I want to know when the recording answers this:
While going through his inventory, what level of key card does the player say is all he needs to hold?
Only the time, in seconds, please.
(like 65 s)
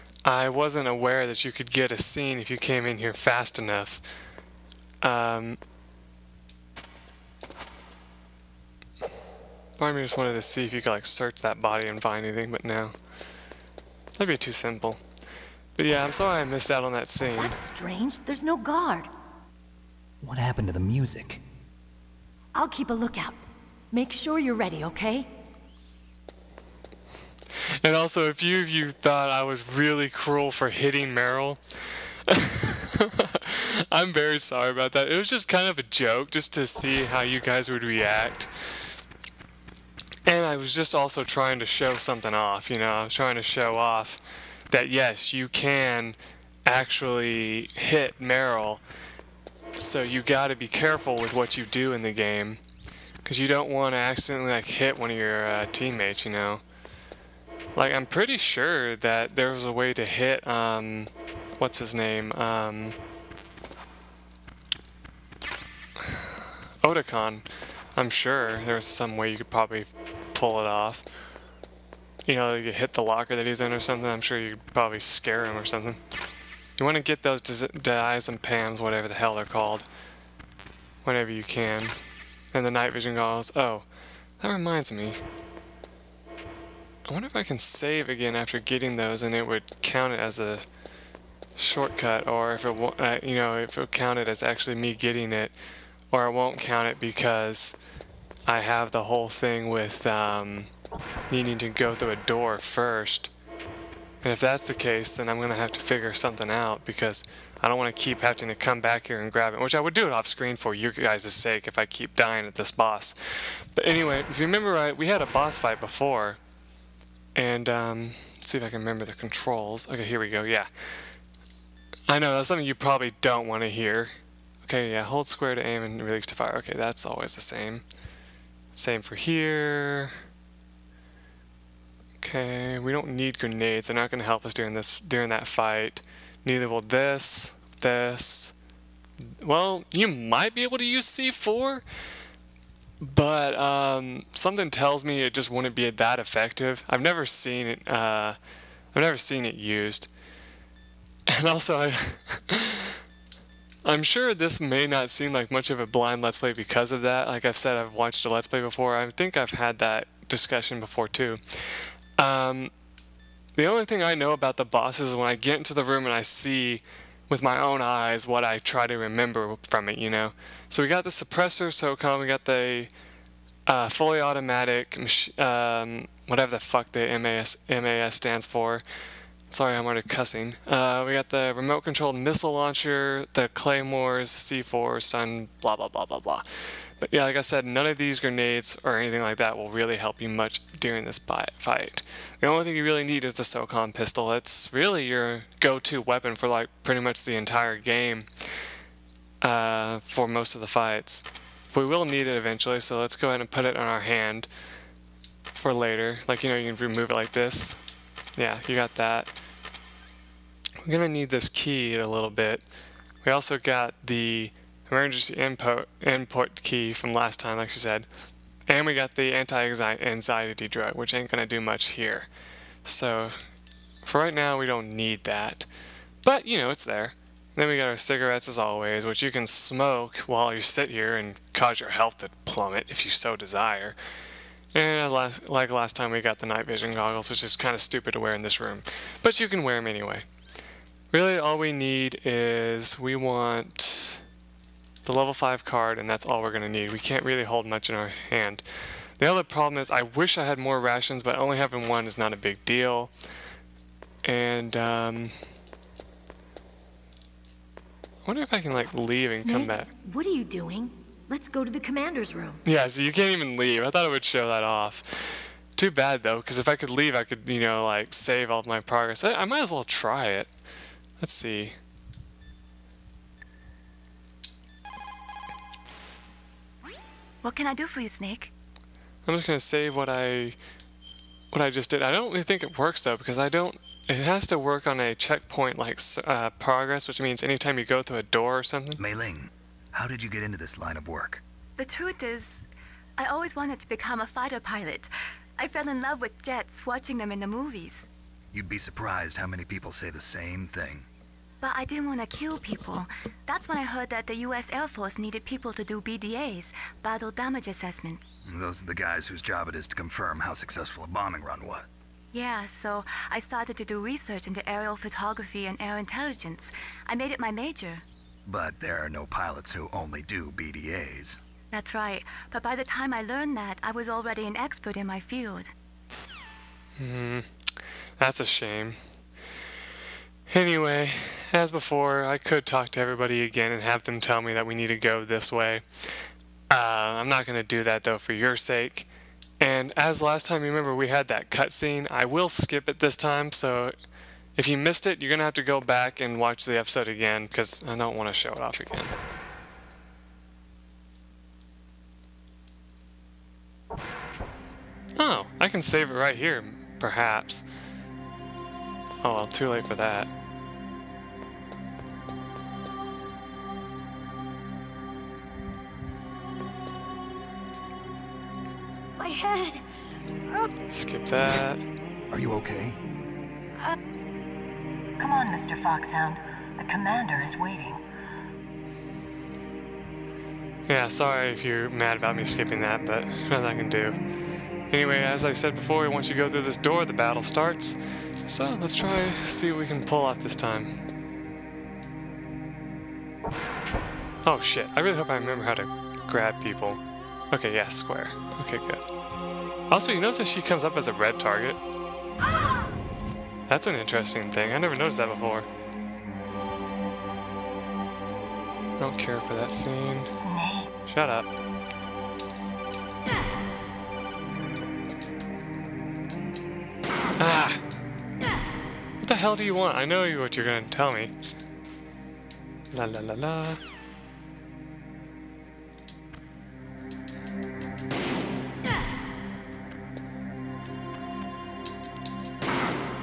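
245 s.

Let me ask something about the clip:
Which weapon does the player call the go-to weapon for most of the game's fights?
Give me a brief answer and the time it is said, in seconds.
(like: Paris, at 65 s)
SOCOM pistol, at 193 s.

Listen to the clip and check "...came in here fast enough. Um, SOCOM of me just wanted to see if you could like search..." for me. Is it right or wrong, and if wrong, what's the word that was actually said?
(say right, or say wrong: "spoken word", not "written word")
wrong: "Part", not "SOCOM".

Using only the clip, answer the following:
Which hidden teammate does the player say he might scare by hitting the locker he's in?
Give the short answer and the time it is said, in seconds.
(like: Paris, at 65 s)
Otacon, at 66 s.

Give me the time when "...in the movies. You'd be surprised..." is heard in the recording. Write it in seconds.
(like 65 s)
297 s.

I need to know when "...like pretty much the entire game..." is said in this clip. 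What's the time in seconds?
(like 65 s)
196 s.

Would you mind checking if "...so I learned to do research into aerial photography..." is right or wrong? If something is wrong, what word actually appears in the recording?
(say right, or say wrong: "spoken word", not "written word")
wrong: "started", not "learned".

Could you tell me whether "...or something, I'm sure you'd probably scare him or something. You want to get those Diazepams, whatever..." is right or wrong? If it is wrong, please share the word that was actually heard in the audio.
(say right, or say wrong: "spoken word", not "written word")
right.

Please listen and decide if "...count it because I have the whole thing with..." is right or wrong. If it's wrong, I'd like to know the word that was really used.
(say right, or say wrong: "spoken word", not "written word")
right.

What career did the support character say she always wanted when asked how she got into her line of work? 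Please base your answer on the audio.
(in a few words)
fighter pilot.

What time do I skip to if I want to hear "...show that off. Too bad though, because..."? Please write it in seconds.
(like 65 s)
264 s.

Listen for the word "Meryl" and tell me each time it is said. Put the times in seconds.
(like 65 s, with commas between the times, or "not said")
31 s, 48 s.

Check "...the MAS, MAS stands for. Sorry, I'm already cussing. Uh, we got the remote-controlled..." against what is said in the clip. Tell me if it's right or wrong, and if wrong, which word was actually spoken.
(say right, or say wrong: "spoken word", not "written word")
right.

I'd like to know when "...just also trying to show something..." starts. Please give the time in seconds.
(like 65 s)
40 s.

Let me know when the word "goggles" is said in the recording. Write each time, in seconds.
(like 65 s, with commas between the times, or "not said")
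83 s, 236 s.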